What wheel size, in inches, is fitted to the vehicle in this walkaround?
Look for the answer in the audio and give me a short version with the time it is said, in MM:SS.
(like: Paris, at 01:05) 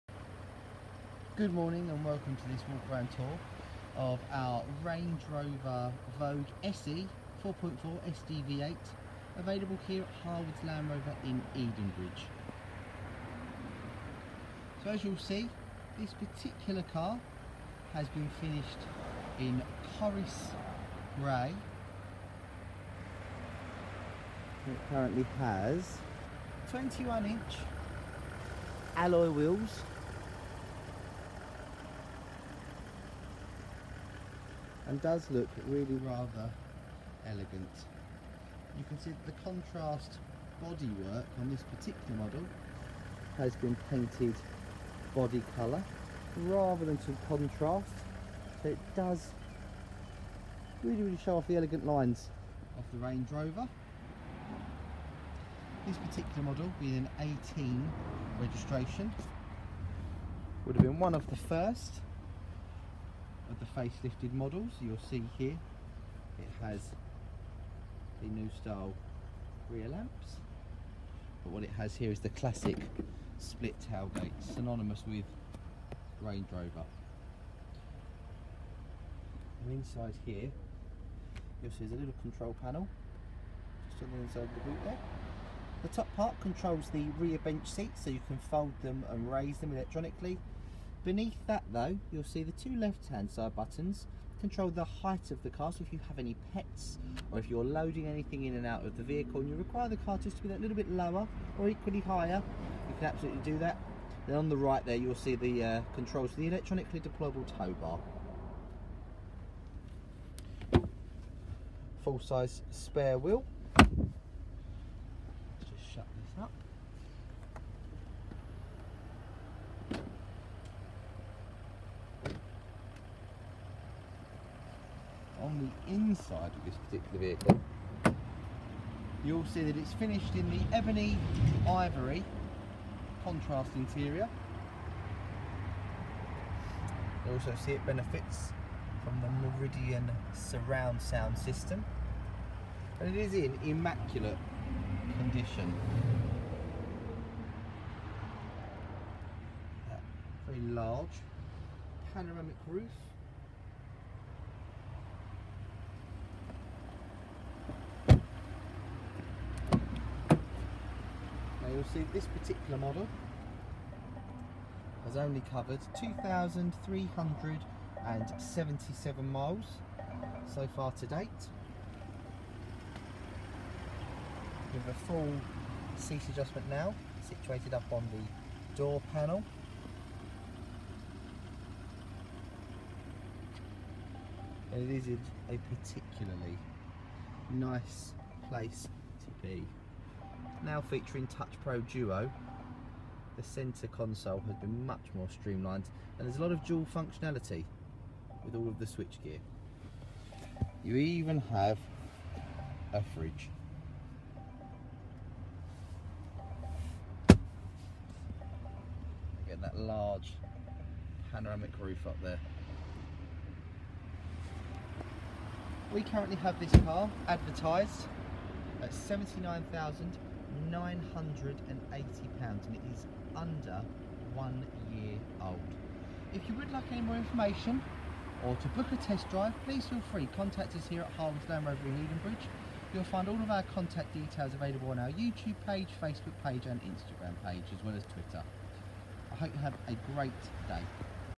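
21 inch, at 00:26.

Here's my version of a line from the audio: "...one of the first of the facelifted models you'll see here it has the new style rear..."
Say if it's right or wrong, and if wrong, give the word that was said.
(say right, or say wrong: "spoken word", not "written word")
right.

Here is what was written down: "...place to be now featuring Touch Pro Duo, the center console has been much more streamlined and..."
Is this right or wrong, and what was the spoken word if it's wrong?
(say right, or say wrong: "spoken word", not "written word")
right.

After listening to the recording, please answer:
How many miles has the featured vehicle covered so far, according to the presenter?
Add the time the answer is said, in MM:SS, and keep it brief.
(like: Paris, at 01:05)
2,377, at 02:45.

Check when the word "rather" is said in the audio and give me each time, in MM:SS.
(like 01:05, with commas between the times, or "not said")
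00:36, 00:46.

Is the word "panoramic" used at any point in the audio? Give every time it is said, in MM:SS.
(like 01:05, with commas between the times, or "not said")
02:32, 03:31.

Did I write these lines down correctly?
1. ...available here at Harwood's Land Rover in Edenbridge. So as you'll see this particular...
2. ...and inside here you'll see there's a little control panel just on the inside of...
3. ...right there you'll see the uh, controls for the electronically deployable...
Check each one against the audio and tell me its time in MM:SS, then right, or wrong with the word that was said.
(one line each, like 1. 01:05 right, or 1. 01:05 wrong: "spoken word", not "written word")
1. 00:09 right
2. 01:19 right
3. 01:44 right.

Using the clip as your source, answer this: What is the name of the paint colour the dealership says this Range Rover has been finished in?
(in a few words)
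Corris Grey.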